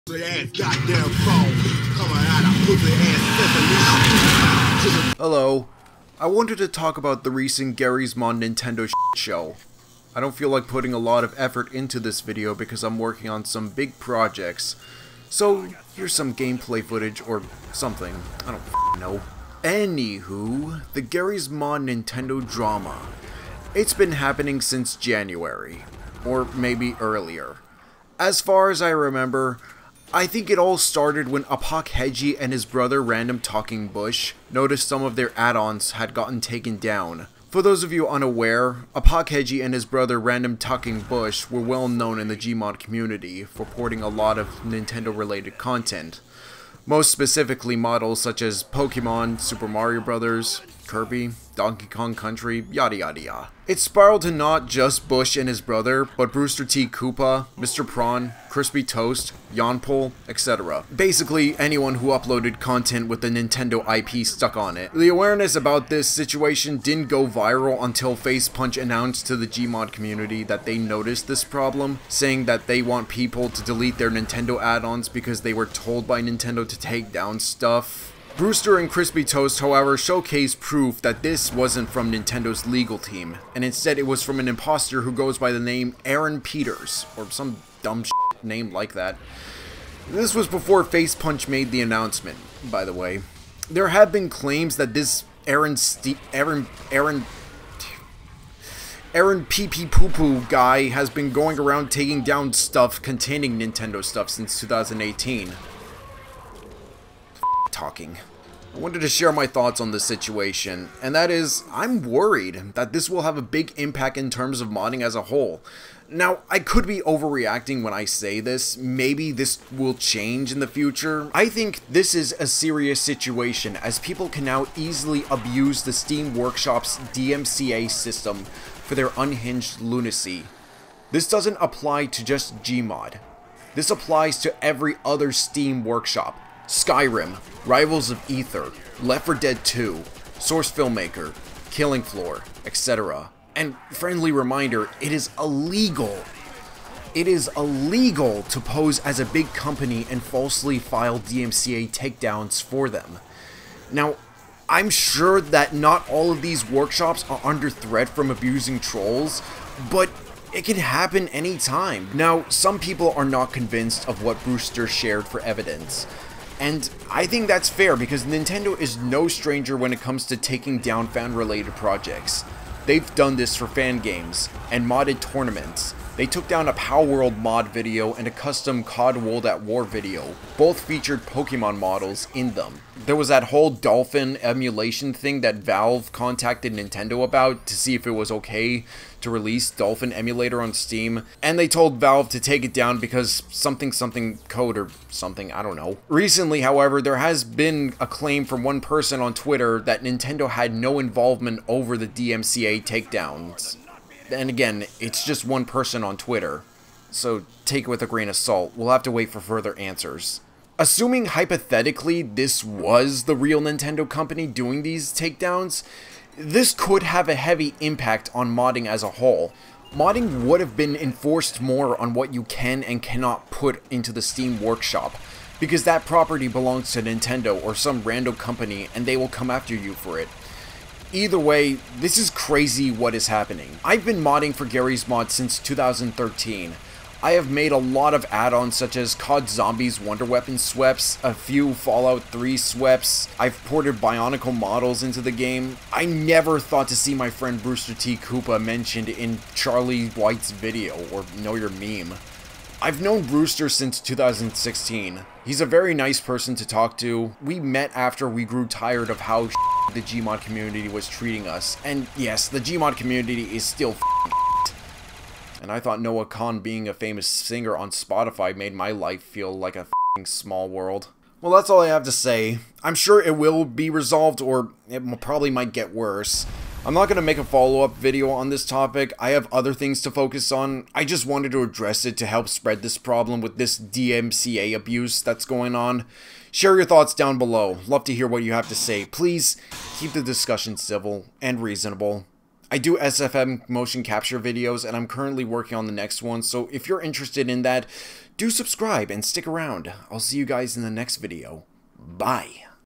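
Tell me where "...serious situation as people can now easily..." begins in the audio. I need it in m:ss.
2:02.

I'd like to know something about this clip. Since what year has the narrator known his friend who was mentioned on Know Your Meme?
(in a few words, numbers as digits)
2016.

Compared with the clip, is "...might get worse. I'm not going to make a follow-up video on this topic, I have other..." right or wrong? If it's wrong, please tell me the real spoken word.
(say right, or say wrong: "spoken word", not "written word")
right.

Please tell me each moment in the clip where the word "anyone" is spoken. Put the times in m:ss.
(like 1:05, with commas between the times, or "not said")
1:01.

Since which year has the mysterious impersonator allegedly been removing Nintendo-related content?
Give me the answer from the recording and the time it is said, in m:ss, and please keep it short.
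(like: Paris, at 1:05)
2018, at 1:44.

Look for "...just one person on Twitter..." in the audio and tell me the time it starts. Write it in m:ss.
3:25.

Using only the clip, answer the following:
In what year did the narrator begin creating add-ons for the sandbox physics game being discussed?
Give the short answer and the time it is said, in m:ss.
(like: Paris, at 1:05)
2013, at 3:55.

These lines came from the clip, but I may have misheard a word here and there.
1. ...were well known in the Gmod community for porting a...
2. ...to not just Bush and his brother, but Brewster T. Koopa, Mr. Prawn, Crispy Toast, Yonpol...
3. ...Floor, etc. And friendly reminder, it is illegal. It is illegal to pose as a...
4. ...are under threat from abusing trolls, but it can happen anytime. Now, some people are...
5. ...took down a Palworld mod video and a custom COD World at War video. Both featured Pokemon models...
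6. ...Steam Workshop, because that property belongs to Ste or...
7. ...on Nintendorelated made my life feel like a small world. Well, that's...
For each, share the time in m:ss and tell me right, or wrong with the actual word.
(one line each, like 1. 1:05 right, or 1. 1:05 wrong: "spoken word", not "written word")
1. 0:41 right
2. 0:54 right
3. 2:22 right
4. 2:37 right
5. 2:56 right
6. 3:44 wrong: "Nintendo", not "Ste"
7. 4:27 wrong: "Spotify", not "Nintendorelated".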